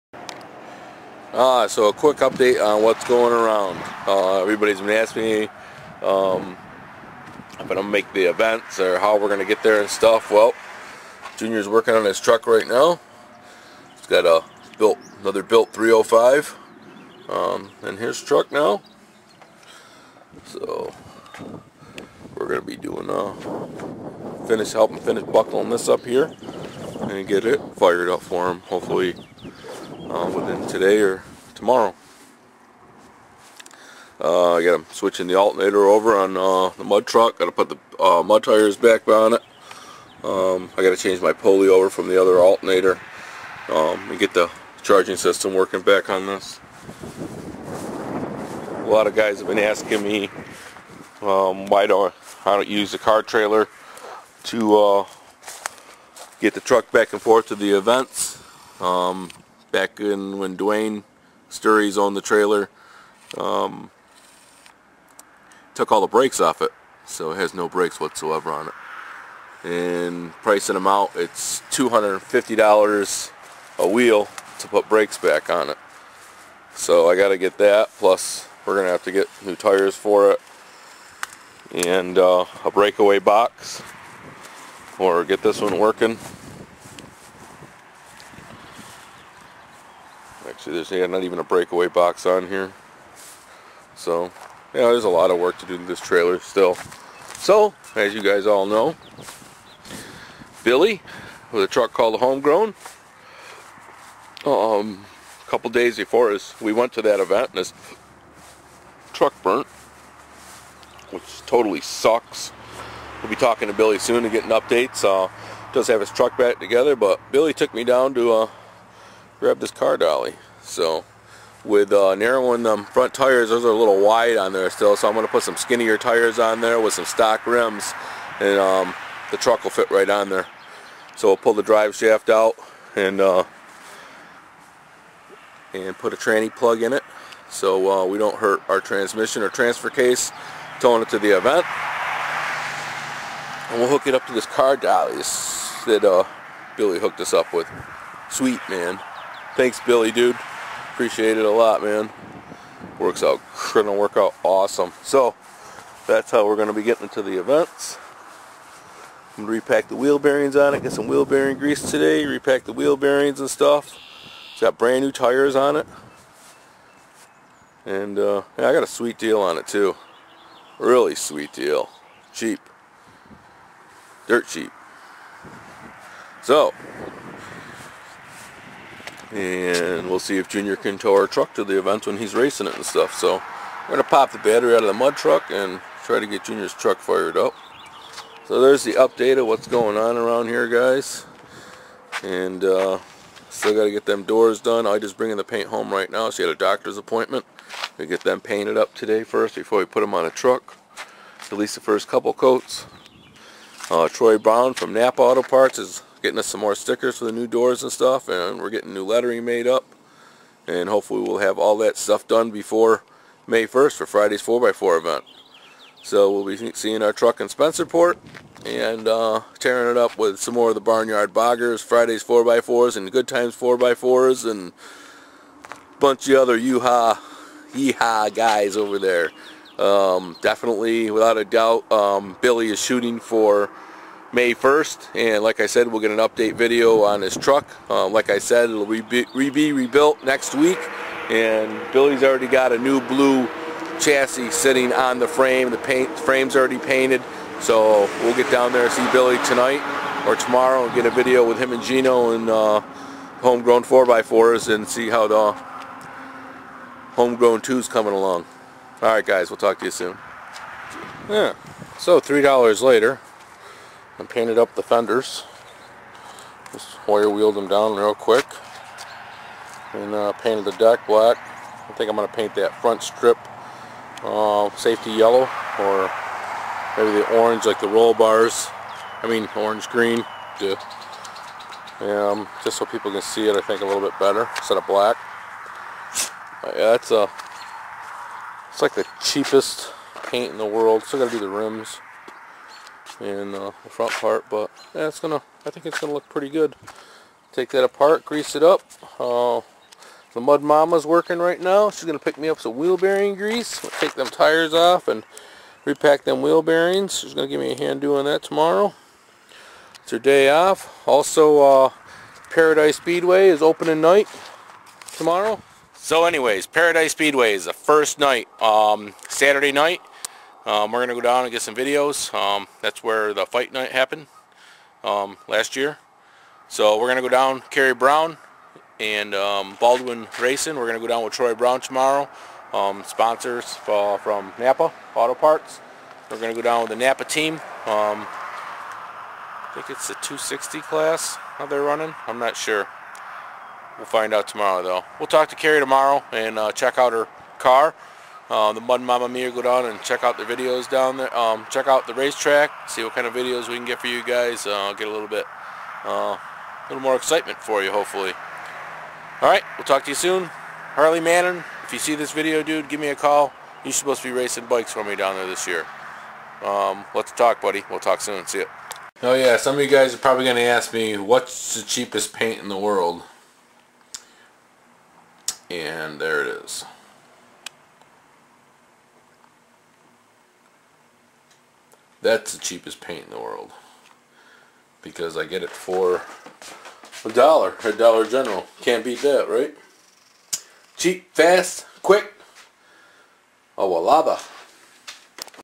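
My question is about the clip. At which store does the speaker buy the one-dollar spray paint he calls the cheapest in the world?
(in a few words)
Dollar General.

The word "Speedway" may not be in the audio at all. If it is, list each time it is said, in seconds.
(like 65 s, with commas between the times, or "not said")
312 s, 317 s.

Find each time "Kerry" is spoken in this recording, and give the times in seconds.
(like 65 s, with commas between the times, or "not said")
327 s.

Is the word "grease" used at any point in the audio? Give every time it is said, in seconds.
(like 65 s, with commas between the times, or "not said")
161 s, 298 s, 303 s.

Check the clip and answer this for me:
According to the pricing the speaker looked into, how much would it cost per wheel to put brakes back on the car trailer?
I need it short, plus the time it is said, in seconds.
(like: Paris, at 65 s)
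$250, at 71 s.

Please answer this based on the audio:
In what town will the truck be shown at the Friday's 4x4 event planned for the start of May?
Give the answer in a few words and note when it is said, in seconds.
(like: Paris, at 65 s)
Spencerport, at 217 s.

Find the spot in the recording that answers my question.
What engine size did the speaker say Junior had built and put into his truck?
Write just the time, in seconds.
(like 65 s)
15 s.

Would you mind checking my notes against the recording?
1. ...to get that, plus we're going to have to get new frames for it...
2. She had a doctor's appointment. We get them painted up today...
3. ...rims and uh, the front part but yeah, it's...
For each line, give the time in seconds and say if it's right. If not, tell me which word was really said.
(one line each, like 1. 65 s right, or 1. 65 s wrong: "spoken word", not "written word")
1. 77 s wrong: "tires", not "frames"
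2. 196 s right
3. 291 s right.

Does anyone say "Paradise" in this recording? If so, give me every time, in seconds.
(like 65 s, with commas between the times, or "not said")
312 s, 316 s.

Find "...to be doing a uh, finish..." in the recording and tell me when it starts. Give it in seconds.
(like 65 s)
22 s.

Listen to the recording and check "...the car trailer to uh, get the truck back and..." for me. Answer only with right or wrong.
right.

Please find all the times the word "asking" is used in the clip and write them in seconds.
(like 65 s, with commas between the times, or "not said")
4 s, 49 s.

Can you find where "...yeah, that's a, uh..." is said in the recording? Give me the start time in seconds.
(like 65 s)
286 s.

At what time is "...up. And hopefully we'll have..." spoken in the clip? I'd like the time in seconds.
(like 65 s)
209 s.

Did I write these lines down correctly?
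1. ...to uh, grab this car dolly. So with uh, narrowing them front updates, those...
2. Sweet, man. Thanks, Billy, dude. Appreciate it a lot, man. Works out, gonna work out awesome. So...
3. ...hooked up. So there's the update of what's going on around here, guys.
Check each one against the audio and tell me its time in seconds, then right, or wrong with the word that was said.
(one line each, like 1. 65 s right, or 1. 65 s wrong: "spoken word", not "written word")
1. 118 s wrong: "tires", not "updates"
2. 148 s right
3. 186 s wrong: "fired", not "hooked".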